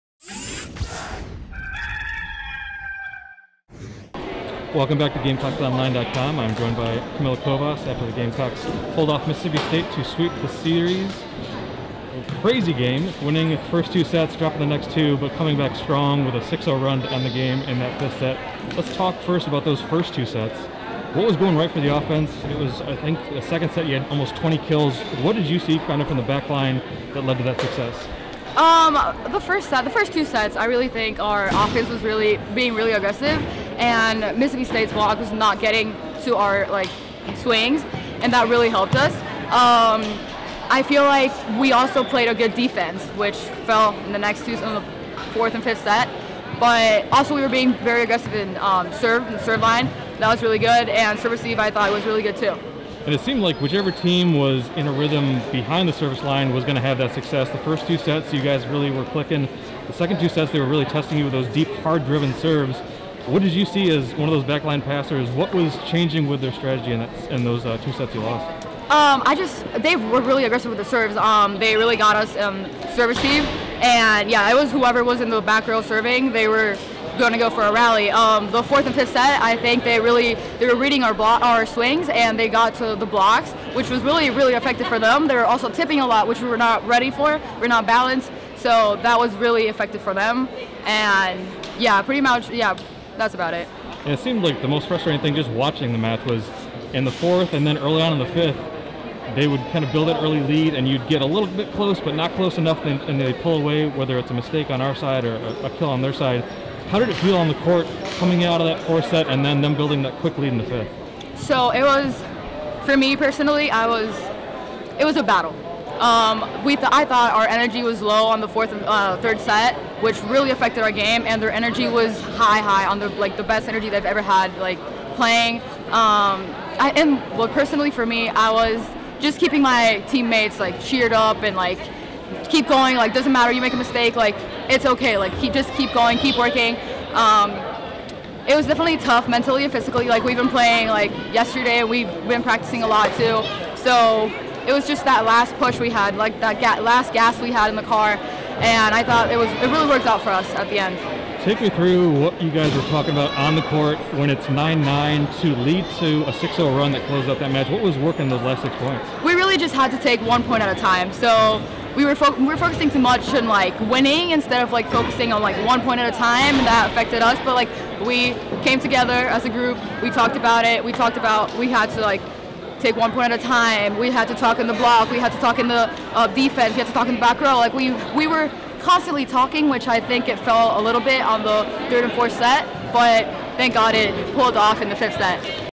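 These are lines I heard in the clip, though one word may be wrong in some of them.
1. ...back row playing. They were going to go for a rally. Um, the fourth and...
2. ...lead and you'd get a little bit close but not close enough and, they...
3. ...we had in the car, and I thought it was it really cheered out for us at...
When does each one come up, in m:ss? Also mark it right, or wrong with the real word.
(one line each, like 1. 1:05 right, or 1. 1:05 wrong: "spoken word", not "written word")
1. 1:15 wrong: "serving", not "playing"
2. 1:40 right
3. 2:27 wrong: "worked", not "cheered".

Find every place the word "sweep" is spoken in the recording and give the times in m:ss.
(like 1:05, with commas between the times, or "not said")
0:10.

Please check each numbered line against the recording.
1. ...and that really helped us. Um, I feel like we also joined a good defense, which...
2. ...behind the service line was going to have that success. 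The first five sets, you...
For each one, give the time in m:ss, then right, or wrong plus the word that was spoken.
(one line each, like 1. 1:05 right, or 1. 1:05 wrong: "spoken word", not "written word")
1. 0:38 wrong: "played", not "joined"
2. 0:55 wrong: "two", not "five".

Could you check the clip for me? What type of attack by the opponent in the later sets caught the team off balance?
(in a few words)
Tipping.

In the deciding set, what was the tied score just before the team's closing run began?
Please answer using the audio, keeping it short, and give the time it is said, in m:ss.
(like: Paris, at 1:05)
9-9, at 2:34.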